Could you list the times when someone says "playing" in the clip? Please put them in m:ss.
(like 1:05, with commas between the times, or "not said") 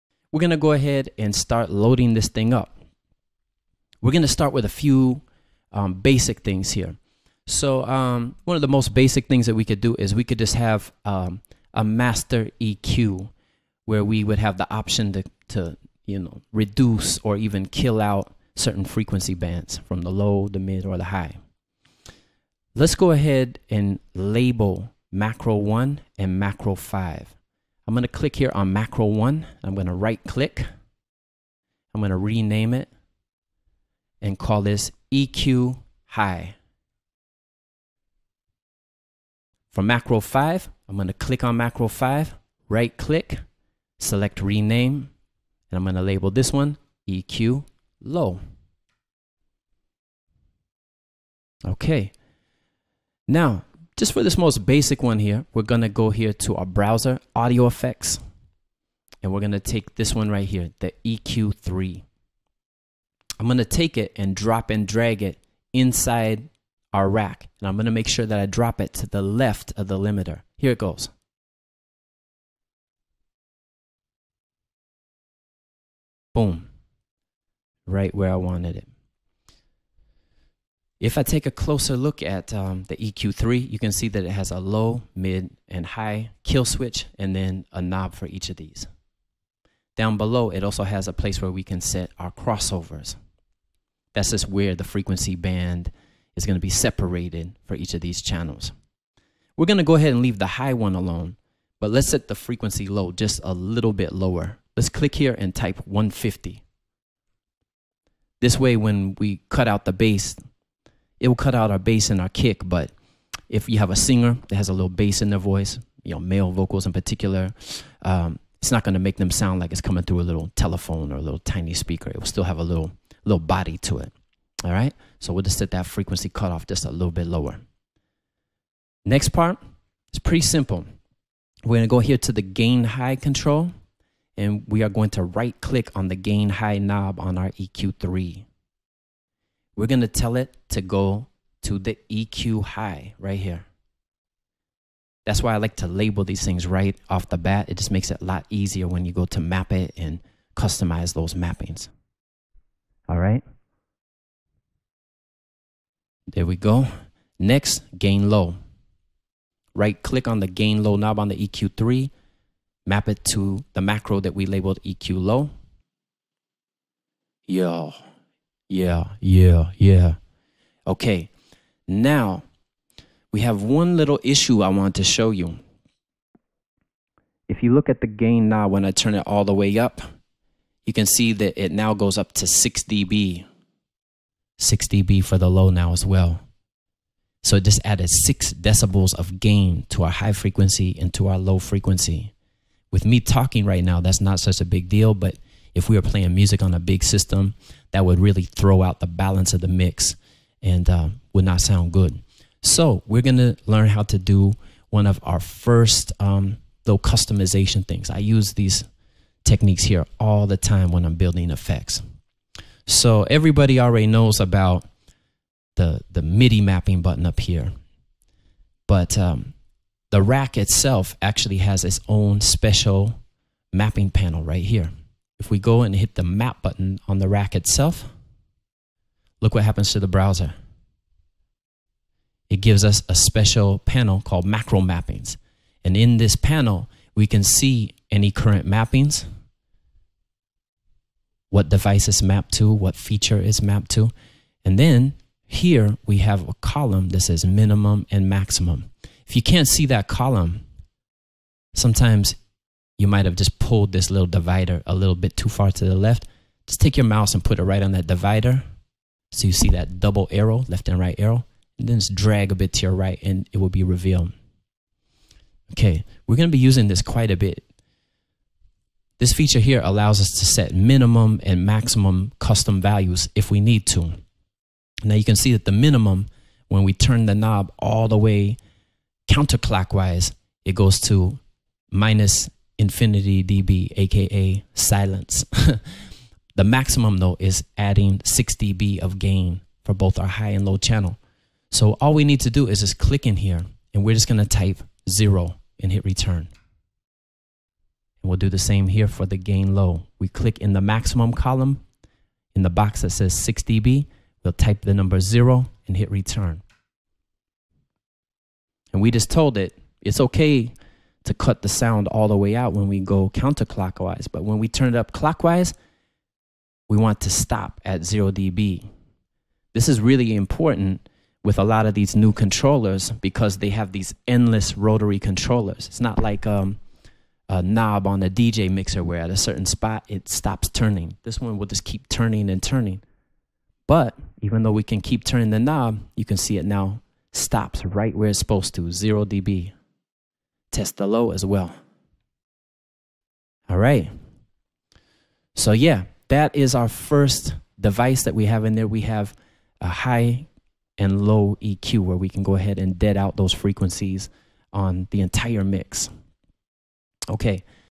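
3:16.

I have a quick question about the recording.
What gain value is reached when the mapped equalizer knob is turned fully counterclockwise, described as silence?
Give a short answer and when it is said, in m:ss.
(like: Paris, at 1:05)
Minus infinity dB, at 4:41.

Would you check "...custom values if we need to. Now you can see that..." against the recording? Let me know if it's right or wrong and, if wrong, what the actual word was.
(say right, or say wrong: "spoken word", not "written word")
right.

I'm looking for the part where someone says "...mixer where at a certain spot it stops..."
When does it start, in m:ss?
5:28.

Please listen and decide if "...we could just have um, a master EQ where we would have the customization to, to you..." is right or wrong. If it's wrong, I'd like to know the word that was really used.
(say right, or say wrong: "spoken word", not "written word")
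wrong: "option", not "customization".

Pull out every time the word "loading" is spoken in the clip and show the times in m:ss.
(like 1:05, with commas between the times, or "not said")
0:01.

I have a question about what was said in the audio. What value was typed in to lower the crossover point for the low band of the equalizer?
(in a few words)
150.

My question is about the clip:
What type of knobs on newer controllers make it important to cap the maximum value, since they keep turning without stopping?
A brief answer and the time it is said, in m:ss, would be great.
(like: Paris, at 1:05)
Endless rotary controllers, at 5:24.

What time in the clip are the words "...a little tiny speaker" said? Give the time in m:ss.
2:01.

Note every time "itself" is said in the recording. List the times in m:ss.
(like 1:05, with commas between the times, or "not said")
3:40, 3:47.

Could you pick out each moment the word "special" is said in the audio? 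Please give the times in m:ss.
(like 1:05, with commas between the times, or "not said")
3:42, 3:53.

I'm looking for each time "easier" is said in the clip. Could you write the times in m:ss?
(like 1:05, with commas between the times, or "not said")
2:28.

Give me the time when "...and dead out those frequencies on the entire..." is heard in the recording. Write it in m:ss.
5:52.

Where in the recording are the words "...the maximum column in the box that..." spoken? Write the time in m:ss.
5:00.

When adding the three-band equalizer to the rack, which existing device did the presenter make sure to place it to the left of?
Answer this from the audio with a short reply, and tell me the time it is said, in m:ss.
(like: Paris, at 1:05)
Limiter, at 1:09.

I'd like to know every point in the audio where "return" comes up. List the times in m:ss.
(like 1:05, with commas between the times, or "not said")
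4:56, 5:06.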